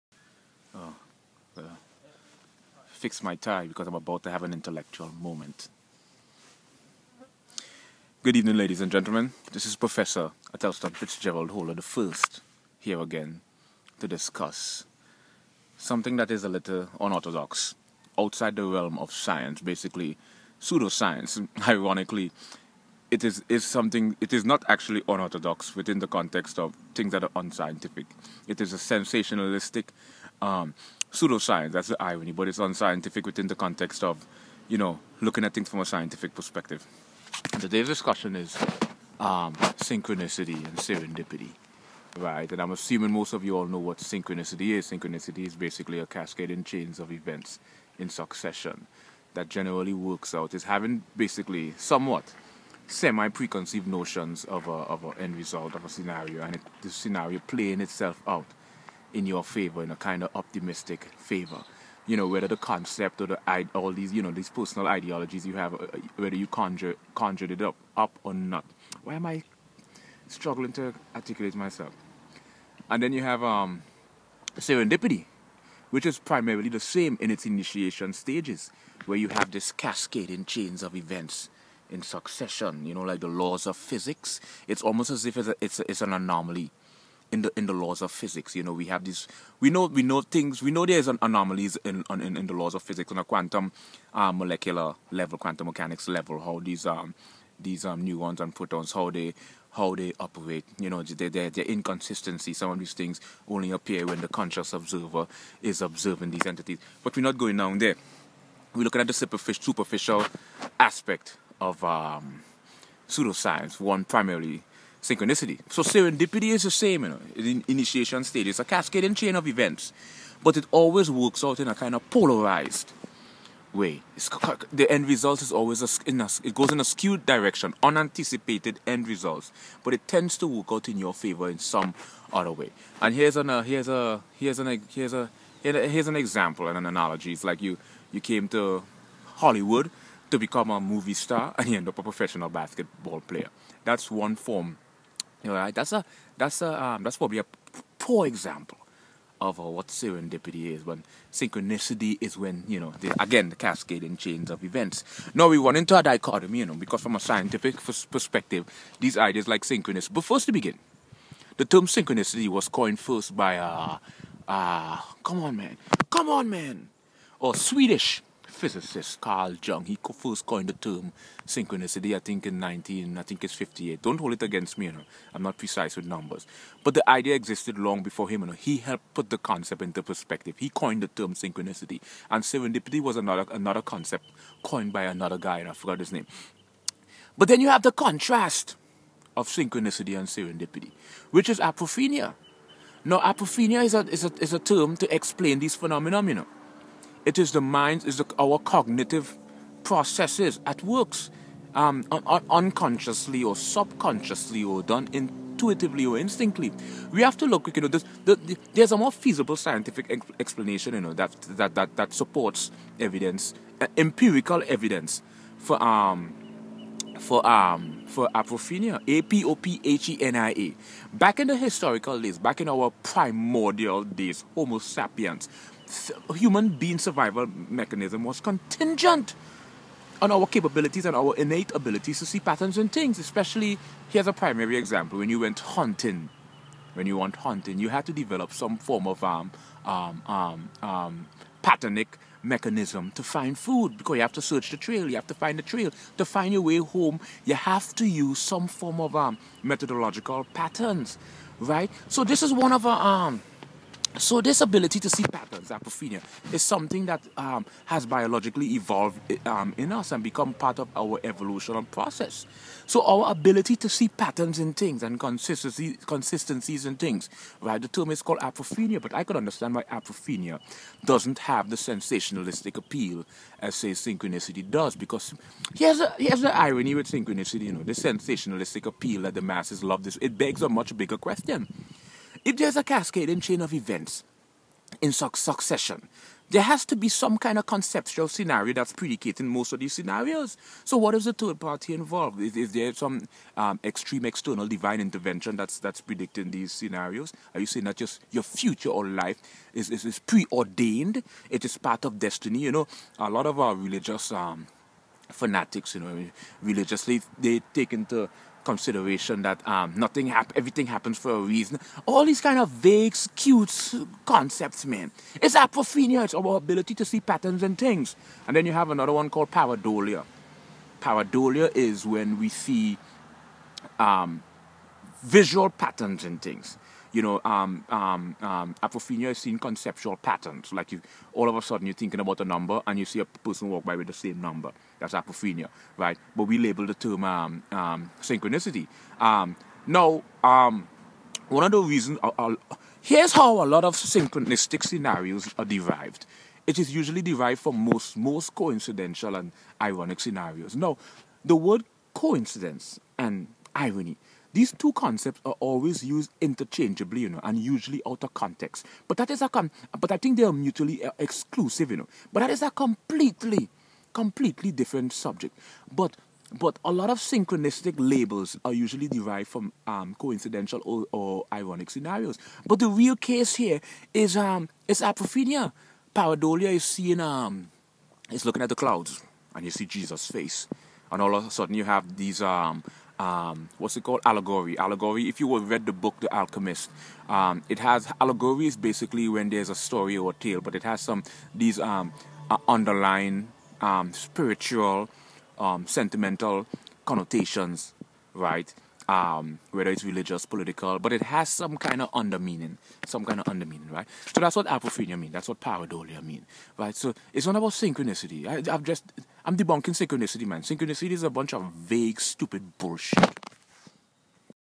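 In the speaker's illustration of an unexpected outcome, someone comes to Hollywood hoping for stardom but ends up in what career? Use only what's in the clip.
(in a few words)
professional basketball player.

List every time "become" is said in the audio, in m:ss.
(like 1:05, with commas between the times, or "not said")
2:20, 4:20.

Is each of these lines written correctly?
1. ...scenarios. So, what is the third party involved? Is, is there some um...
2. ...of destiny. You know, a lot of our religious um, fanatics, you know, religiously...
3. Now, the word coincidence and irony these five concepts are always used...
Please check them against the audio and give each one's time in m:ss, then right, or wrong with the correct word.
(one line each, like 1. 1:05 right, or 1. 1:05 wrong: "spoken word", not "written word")
1. 4:49 right
2. 5:02 right
3. 5:50 wrong: "two", not "five".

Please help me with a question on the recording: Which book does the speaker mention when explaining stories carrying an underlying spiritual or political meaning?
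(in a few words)
The Alchemist.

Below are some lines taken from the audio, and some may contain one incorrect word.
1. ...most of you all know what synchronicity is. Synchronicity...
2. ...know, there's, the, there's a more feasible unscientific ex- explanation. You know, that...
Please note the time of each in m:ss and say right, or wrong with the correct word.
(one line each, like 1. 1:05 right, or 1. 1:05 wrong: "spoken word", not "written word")
1. 0:43 right
2. 3:27 wrong: "scientific", not "unscientific".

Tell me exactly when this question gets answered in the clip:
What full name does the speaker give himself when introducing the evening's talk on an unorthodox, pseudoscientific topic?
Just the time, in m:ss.
0:10.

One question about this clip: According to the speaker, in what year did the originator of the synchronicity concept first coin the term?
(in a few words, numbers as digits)
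1958.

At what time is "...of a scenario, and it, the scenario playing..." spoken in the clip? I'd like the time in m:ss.
0:55.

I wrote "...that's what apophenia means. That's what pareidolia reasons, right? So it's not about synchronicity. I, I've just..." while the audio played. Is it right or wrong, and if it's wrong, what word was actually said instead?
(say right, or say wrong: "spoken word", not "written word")
wrong: "means", not "reasons".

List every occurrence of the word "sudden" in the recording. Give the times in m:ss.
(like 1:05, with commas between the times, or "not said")
5:31, 6:21.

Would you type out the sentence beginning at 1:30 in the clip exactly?
We know there's an anomalies in, in in the laws of physics on a quantum, uh, molecular level, quantum mechanics level.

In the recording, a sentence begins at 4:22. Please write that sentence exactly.
So our ability to see patterns in things and consistency, consistencies in things, right?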